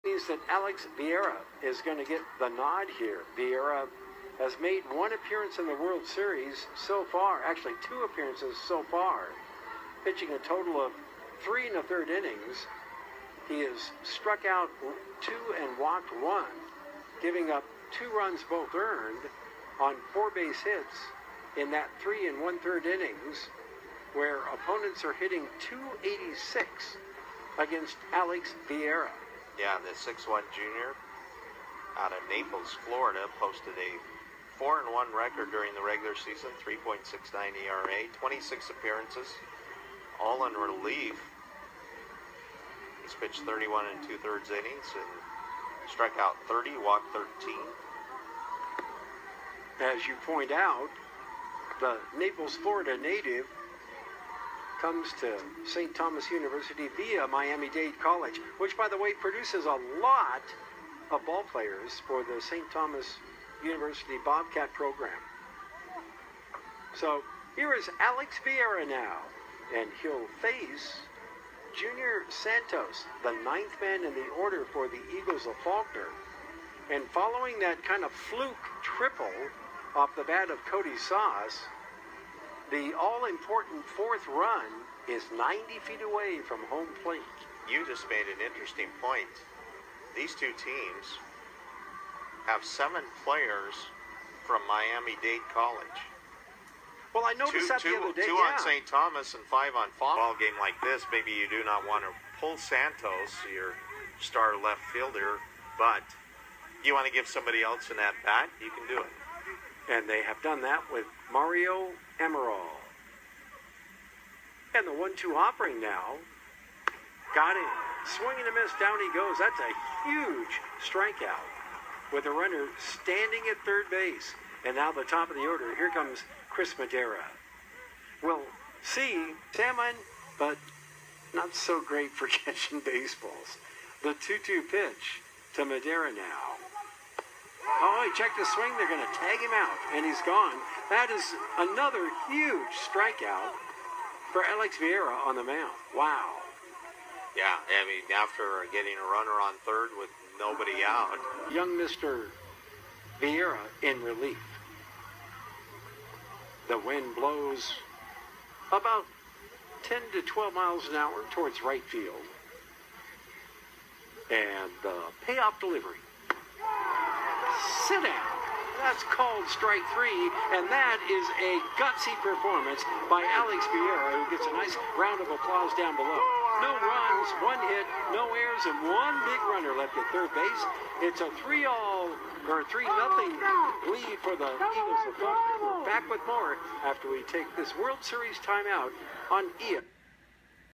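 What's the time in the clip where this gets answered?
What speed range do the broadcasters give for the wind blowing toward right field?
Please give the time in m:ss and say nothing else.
2:39.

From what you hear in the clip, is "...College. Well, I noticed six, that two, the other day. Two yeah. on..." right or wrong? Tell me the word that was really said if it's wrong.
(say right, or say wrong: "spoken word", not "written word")
wrong: "two", not "six".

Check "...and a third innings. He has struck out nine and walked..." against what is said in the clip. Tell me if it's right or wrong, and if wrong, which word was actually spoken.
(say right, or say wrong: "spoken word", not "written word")
wrong: "two", not "nine".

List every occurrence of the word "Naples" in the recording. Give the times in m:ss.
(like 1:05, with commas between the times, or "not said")
0:32, 0:52.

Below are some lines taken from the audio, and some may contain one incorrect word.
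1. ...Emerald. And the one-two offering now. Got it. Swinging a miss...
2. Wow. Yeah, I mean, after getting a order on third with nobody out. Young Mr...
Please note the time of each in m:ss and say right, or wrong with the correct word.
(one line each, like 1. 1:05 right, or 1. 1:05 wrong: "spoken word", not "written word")
1. 1:52 right
2. 2:25 wrong: "runner", not "order".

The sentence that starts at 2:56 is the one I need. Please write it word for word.
No runs, one hit, no errors, and one big runner left at third base.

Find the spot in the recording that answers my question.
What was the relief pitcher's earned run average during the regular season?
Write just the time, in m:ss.
0:36.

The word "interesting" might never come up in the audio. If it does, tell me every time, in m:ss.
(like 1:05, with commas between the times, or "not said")
1:28.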